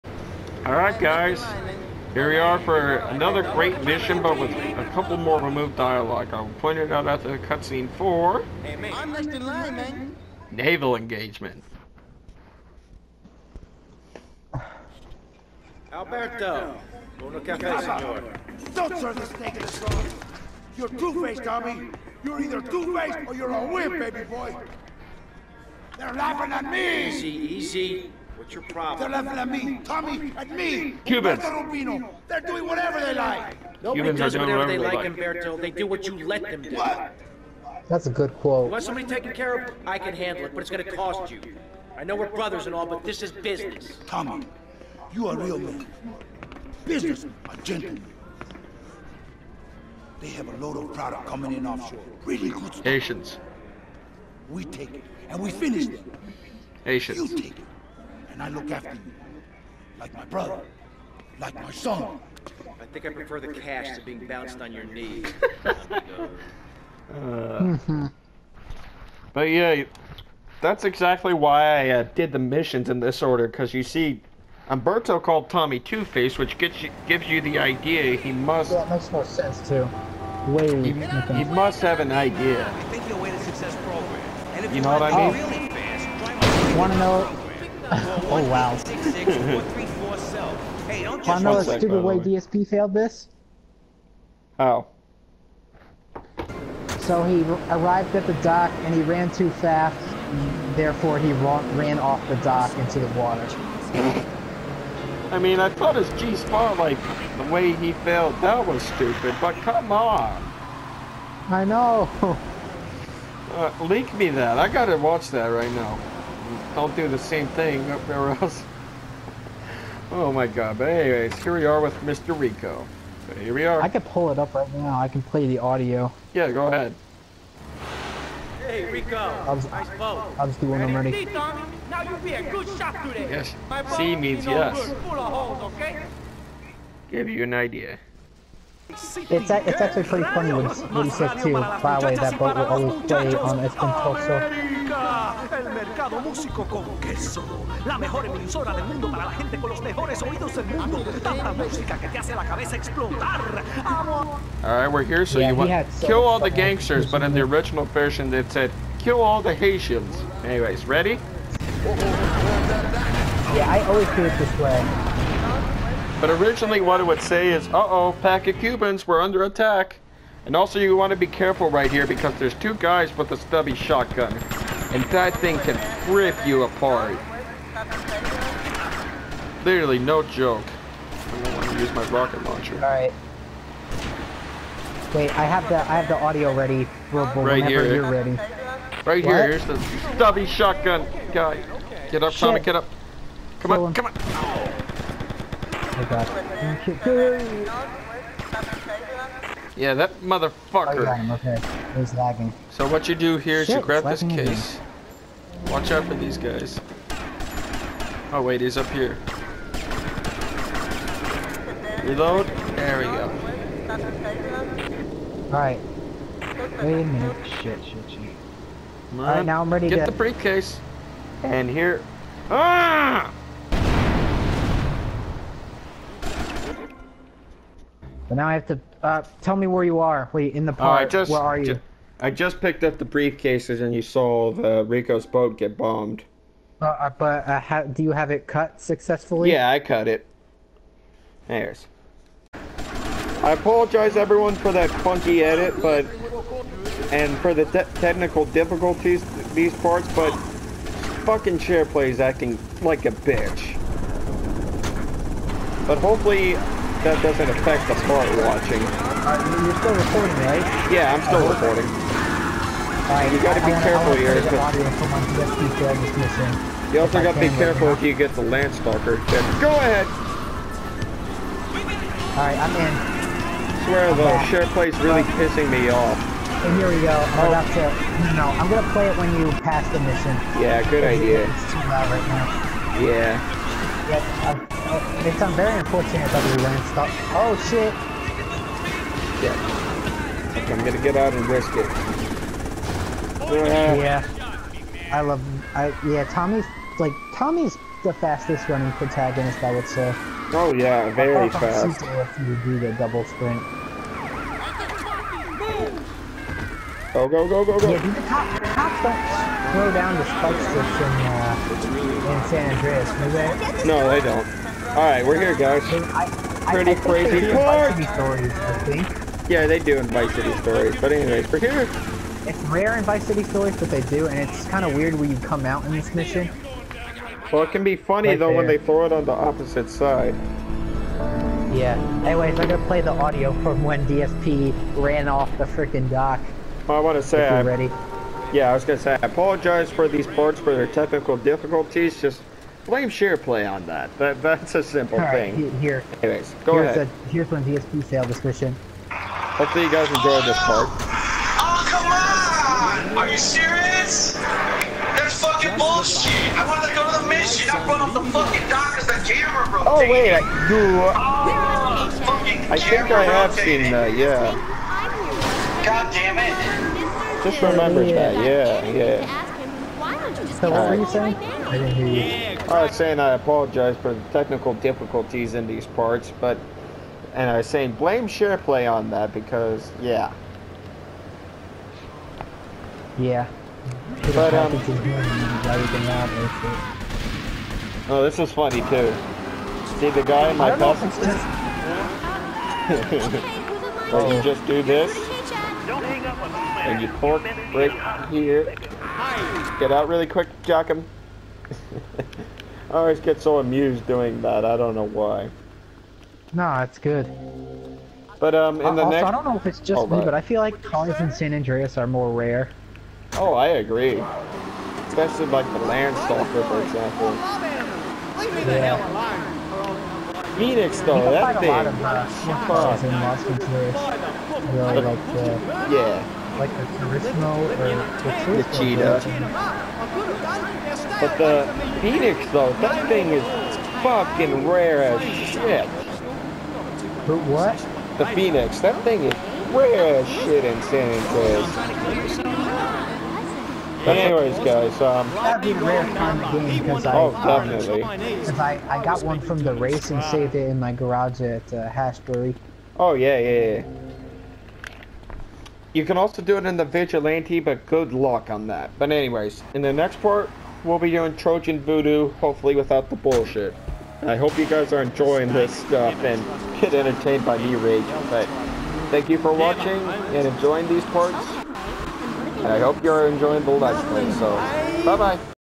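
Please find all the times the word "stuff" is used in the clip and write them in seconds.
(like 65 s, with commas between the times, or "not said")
52 s, 465 s.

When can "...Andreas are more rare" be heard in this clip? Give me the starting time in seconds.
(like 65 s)
411 s.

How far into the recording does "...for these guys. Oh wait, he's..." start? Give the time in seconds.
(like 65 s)
206 s.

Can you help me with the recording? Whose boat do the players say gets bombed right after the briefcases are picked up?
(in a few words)
Rico's boat.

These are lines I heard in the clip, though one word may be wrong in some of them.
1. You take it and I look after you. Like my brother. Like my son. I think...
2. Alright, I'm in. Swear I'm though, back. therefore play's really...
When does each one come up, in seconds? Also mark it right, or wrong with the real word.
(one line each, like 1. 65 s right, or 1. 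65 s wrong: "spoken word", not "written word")
1. 57 s right
2. 272 s wrong: "share", not "therefore".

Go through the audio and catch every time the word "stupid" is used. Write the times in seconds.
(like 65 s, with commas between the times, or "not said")
91 s, 108 s.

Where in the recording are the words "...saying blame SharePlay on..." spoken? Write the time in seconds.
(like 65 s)
377 s.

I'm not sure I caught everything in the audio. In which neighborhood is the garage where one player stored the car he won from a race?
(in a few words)
Hashbury.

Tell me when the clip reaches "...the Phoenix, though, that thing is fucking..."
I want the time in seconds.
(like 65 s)
431 s.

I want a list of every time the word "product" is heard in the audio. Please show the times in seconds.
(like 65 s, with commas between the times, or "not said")
50 s.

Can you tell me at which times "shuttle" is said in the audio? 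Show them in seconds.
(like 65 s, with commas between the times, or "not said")
not said.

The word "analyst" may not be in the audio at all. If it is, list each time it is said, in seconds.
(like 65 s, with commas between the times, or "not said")
not said.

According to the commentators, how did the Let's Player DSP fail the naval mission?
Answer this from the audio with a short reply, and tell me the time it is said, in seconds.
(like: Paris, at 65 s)
Ran off the dock, at 101 s.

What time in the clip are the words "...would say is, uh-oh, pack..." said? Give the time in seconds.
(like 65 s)
167 s.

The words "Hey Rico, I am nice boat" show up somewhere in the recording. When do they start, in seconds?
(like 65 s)
128 s.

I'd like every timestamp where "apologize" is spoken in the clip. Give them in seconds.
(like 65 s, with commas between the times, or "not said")
243 s, 339 s, 373 s.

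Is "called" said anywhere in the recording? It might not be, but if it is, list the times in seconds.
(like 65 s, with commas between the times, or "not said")
75 s.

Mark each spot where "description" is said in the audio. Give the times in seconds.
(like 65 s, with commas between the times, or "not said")
348 s.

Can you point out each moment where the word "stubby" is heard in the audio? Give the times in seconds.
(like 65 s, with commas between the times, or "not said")
173 s, 190 s.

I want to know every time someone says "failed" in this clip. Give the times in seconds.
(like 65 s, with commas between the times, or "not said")
92 s, 107 s.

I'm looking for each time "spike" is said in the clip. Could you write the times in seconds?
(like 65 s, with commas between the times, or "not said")
310 s.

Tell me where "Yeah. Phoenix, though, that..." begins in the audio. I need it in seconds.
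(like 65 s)
418 s.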